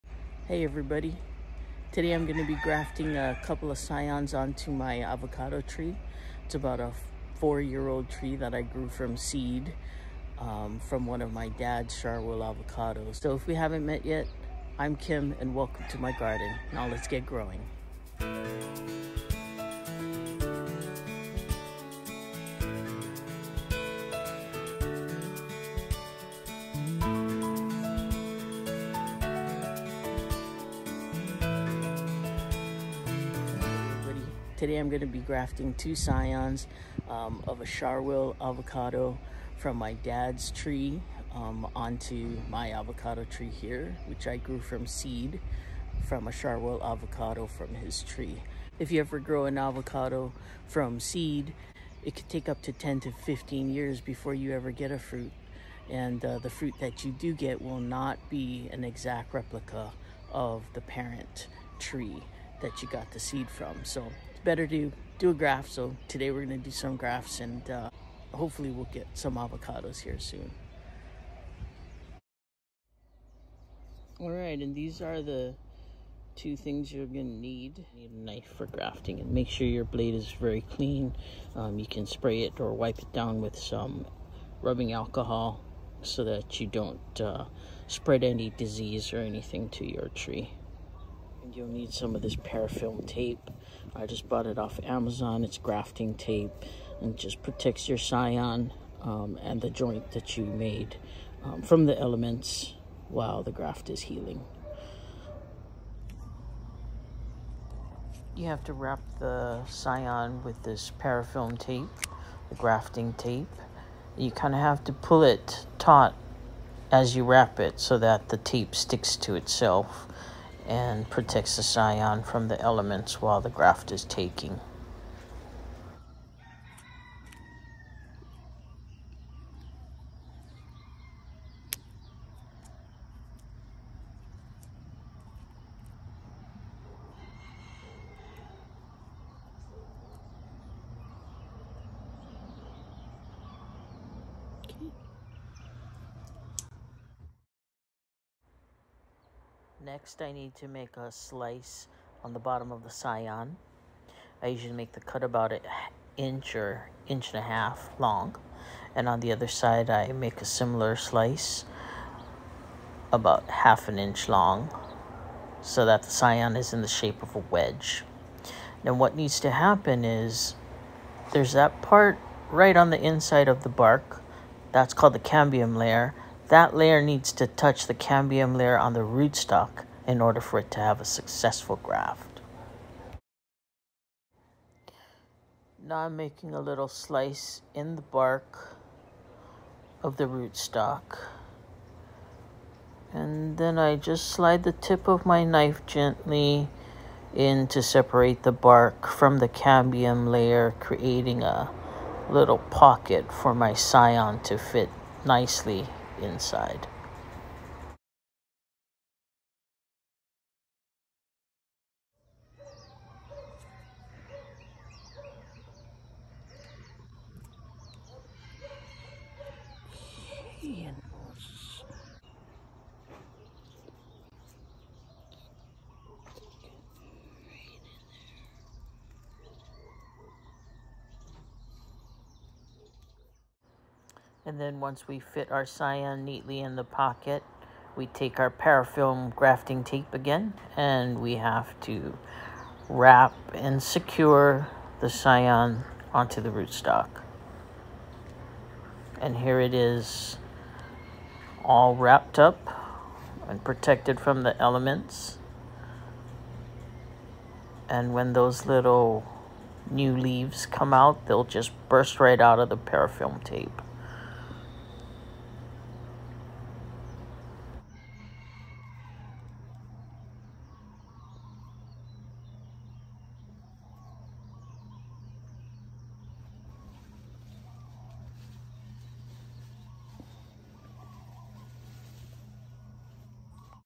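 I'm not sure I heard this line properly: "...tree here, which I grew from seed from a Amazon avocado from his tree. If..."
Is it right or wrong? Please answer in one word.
wrong.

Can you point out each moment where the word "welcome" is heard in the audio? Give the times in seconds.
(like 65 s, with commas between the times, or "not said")
15 s.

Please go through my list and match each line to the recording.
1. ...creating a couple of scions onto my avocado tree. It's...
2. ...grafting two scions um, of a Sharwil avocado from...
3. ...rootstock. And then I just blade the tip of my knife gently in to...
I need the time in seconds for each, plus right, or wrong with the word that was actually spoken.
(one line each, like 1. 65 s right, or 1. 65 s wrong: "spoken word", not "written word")
1. 2 s wrong: "grafting", not "creating"
2. 35 s right
3. 190 s wrong: "slide", not "blade".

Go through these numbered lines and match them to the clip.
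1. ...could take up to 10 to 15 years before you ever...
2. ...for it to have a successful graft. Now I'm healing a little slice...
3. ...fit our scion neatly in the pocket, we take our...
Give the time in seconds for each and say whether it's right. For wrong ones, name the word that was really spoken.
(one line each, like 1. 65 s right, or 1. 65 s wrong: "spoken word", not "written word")
1. 52 s right
2. 180 s wrong: "making", not "healing"
3. 235 s right.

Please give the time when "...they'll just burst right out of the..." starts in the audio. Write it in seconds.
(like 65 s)
261 s.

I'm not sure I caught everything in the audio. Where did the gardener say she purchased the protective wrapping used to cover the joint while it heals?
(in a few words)
Amazon.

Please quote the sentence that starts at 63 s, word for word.
So better to do a graft.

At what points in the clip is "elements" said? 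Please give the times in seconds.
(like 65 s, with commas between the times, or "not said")
101 s, 122 s, 254 s.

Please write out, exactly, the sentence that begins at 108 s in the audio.
You have to wrap the scion with this parafilm tape, the grafting tape.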